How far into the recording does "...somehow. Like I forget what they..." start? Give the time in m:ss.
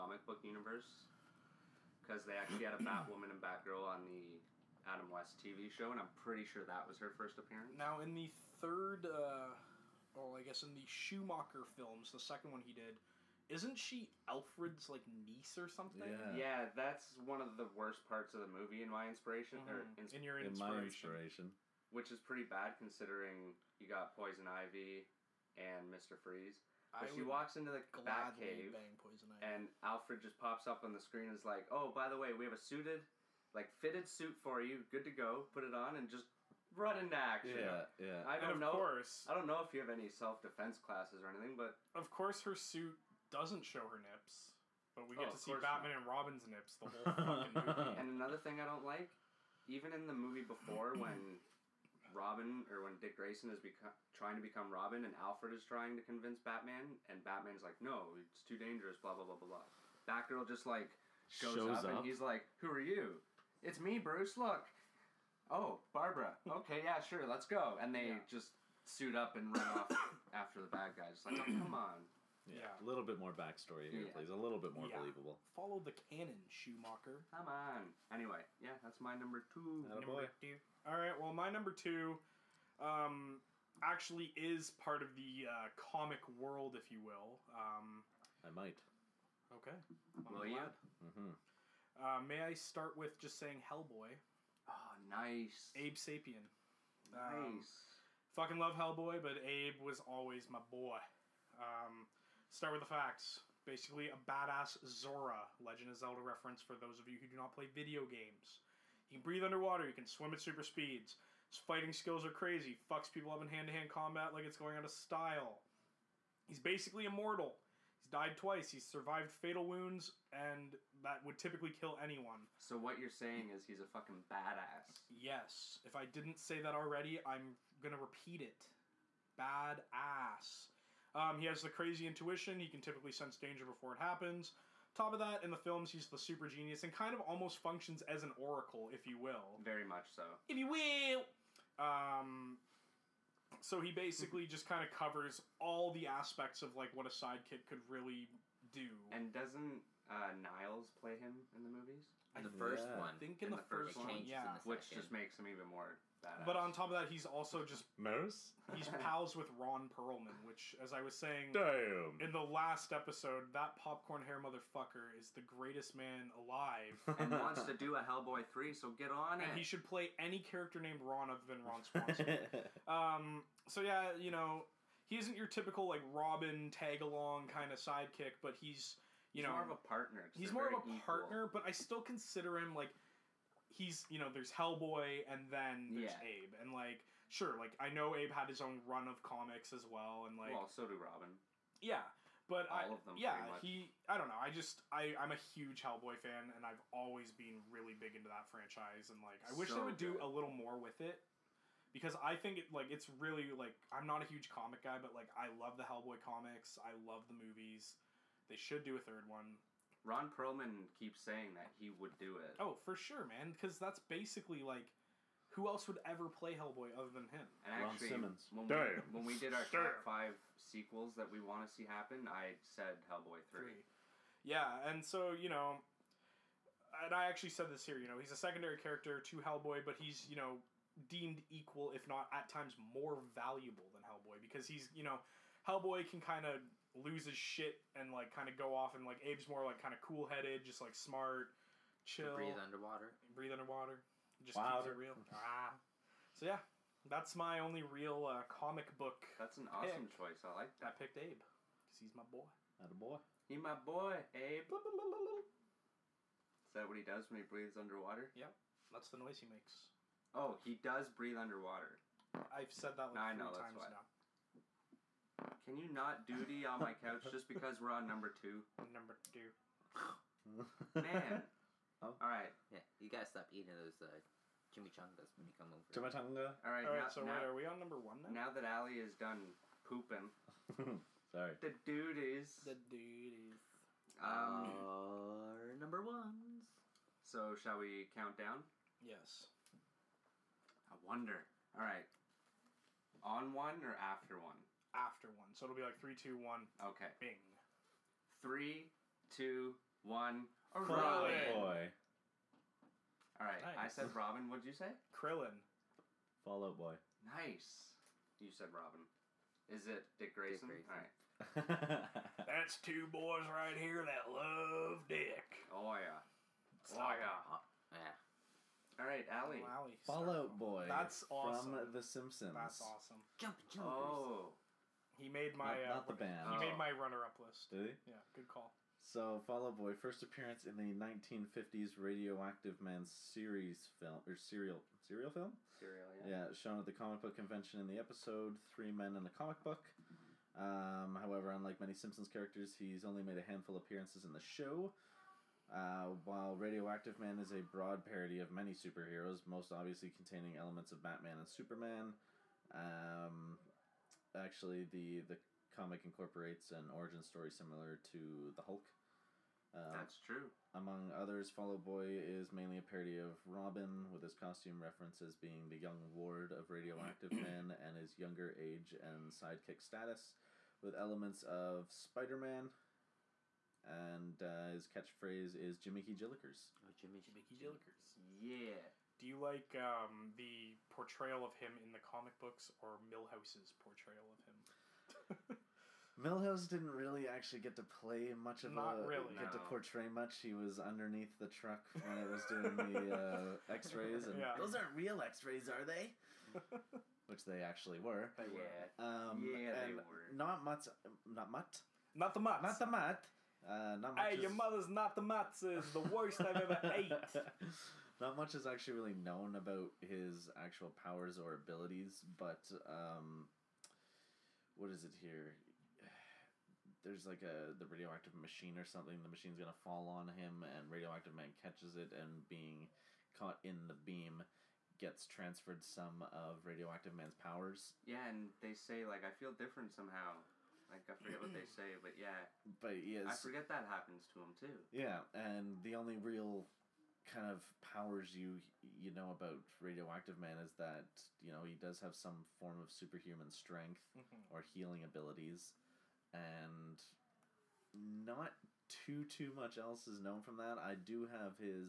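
7:09.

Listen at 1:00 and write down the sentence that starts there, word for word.
Batgirl just like goes Shows up, up and he's like, who are you?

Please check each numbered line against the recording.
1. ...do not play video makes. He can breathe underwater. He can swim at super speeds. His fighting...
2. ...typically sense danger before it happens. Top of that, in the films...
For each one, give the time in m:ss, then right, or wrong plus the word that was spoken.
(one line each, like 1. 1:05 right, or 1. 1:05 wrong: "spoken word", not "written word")
1. 1:47 wrong: "games", not "makes"
2. 2:12 right.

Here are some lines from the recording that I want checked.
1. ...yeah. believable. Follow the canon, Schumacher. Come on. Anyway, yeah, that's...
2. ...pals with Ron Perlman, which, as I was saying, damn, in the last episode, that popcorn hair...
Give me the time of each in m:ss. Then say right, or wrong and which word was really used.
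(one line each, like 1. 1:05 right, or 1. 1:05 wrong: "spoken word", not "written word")
1. 1:14 right
2. 2:38 right.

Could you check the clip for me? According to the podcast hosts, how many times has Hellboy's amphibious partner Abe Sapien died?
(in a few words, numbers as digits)
2.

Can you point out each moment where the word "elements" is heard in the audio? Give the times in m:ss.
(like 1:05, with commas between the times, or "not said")
5:50, 6:10.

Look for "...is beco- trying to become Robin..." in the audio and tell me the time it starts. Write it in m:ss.
0:53.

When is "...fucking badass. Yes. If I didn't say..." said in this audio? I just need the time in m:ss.
2:03.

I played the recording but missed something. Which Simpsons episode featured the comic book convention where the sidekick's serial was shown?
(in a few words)
Three Men and a Comic Book.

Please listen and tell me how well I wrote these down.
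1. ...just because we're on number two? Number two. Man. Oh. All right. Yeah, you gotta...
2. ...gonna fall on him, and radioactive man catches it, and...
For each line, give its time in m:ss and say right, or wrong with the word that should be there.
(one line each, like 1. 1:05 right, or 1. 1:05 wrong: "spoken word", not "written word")
1. 4:27 right
2. 6:59 right.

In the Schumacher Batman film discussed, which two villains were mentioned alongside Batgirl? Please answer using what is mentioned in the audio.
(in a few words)
Poison Ivy and Mister Freeze.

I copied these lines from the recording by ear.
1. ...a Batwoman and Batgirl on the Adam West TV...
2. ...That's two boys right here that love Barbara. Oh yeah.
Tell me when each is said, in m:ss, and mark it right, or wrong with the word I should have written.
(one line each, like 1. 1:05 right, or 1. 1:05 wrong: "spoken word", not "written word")
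1. 0:02 right
2. 5:12 wrong: "Dick", not "Barbara".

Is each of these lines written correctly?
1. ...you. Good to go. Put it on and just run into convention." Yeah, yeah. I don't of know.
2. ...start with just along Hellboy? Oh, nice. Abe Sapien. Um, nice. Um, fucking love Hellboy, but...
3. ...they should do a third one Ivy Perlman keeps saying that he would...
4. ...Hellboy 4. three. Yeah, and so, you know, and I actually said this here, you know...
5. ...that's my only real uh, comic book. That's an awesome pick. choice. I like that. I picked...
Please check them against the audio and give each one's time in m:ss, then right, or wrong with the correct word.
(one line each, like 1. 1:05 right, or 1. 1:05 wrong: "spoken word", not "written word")
1. 0:34 wrong: "action", not "convention"
2. 1:32 wrong: "saying", not "along"
3. 3:28 wrong: "Ron", not "Ivy"
4. 3:43 wrong: "3", not "4"
5. 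4:07 right.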